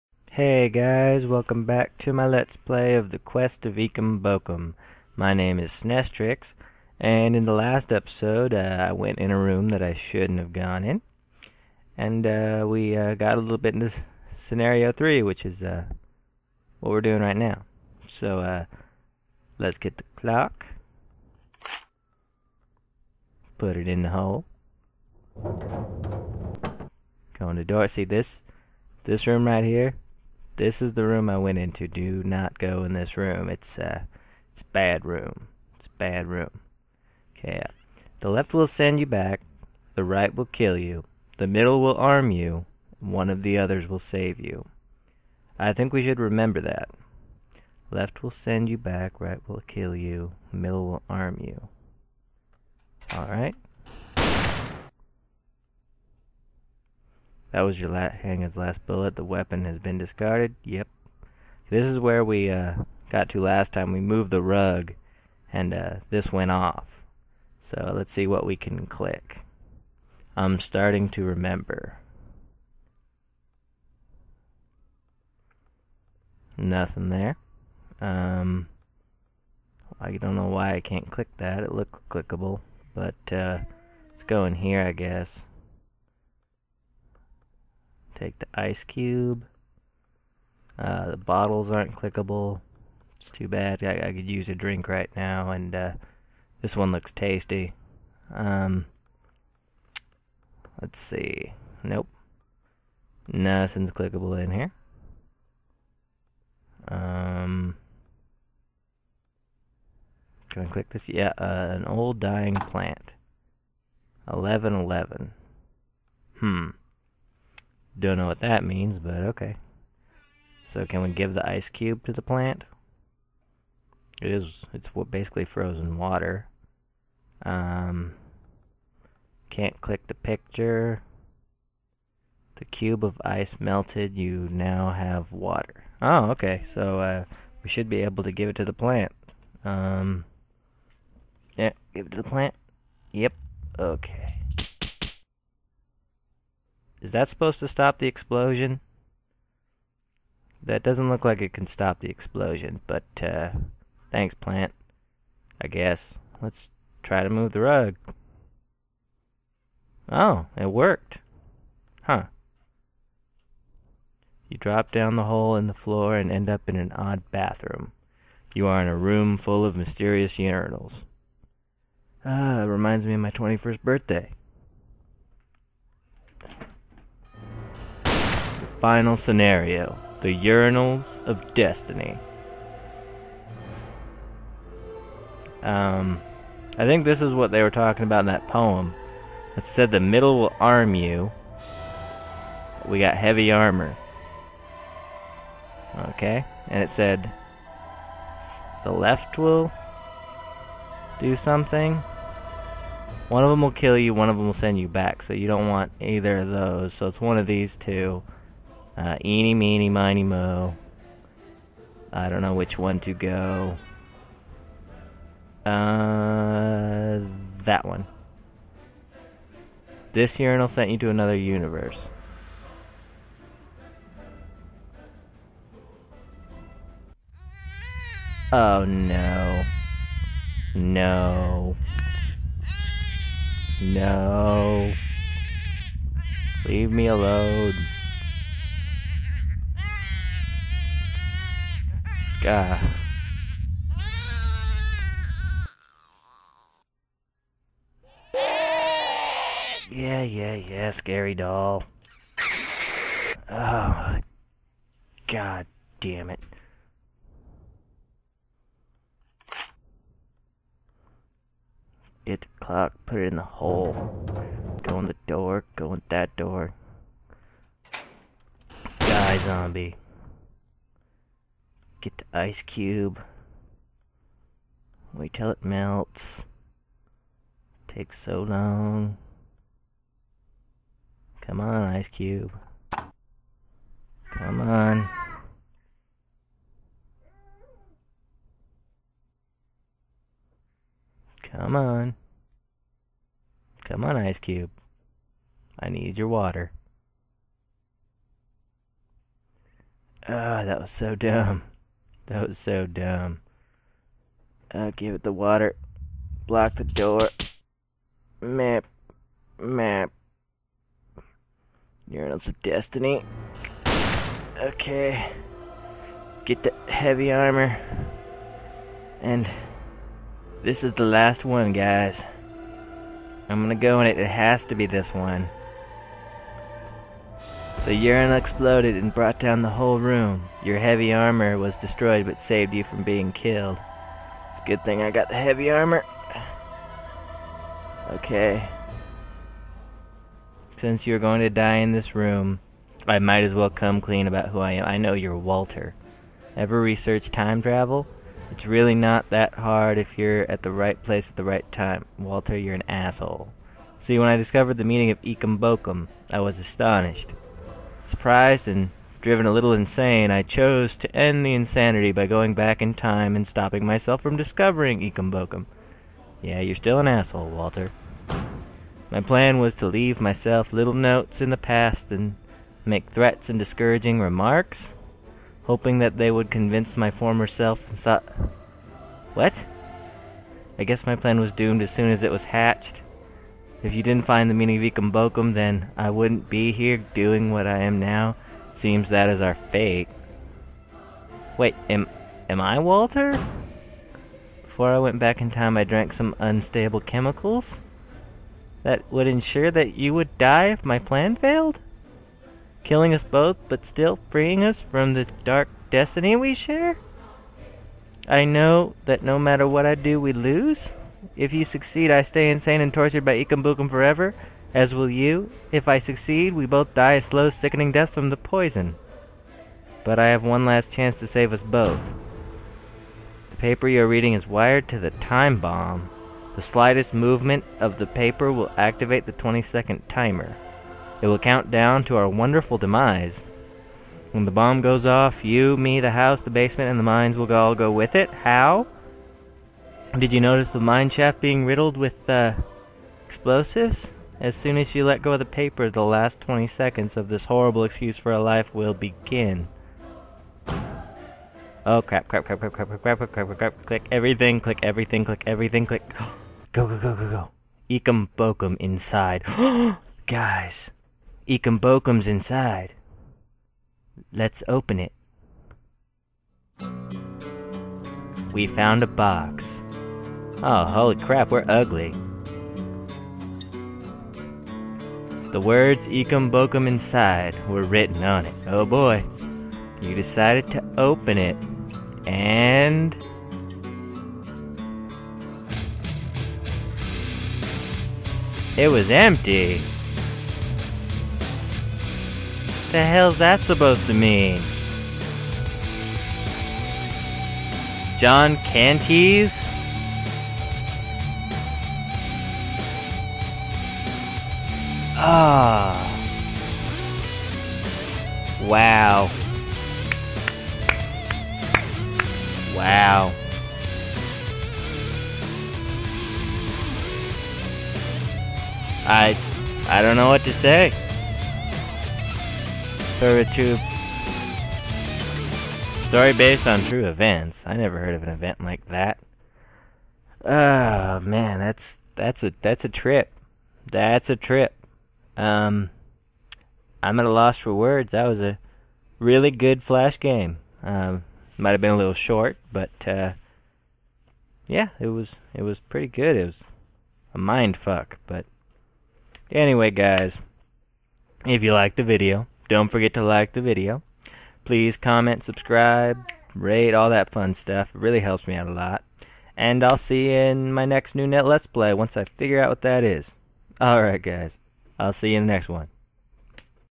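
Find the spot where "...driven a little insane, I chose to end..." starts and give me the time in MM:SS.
05:59.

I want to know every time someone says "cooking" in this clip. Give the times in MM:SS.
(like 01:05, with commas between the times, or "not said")
not said.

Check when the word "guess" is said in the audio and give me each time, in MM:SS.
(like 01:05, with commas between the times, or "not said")
01:24, 02:35, 06:20.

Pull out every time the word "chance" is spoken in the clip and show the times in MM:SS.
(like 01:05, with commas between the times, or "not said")
07:00.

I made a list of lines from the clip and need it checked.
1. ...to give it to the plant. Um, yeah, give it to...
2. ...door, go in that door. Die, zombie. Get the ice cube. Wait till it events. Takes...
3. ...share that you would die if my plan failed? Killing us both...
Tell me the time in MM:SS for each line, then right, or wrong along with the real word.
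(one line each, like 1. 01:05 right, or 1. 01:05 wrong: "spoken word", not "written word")
1. 02:18 right
2. 04:25 wrong: "melts", not "events"
3. 06:39 wrong: "ensure", not "share".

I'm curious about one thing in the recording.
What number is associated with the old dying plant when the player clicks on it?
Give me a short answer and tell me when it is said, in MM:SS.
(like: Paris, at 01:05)
1111, at 01:54.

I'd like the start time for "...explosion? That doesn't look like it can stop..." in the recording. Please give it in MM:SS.
02:28.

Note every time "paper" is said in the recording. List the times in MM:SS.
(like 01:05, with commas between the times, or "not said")
07:03, 07:08, 07:25.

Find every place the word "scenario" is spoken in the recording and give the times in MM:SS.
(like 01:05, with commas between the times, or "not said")
00:14, 02:59.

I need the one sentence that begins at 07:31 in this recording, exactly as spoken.
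Oh crap, crap, crap, crap, crap, crap, crap, crap, crap, crap, crap, click everything, click everything, click everything, click.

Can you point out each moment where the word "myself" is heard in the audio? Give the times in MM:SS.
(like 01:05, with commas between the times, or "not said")
06:03, 06:10.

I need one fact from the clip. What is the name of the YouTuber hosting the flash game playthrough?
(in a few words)
Snestrix.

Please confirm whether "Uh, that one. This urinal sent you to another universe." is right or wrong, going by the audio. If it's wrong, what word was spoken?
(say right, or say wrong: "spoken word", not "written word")
right.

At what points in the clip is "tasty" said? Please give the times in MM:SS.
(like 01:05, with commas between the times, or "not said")
01:37.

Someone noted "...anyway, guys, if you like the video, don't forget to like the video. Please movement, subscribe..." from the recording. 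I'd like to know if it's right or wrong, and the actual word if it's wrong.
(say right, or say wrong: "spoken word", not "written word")
wrong: "comment", not "movement".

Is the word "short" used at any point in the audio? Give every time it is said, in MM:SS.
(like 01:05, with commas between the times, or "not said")
09:02.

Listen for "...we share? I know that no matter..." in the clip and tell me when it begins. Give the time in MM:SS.
06:46.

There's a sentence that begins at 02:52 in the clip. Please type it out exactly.
Ah, it reminds me of my 21st birthday.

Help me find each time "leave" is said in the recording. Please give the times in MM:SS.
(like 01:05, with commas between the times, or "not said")
03:56, 06:09.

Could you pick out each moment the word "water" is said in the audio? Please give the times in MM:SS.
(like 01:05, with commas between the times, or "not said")
02:05, 02:15, 04:56, 05:05.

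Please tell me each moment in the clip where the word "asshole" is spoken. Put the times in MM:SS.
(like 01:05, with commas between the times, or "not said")
05:52, 06:07.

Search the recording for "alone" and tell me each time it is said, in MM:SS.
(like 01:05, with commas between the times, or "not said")
03:57.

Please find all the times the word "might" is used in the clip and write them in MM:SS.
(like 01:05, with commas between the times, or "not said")
05:43, 09:01.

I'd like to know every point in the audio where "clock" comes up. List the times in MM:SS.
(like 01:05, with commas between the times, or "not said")
00:20, 04:22.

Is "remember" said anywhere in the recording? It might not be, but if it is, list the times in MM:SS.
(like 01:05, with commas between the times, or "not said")
00:46, 01:11.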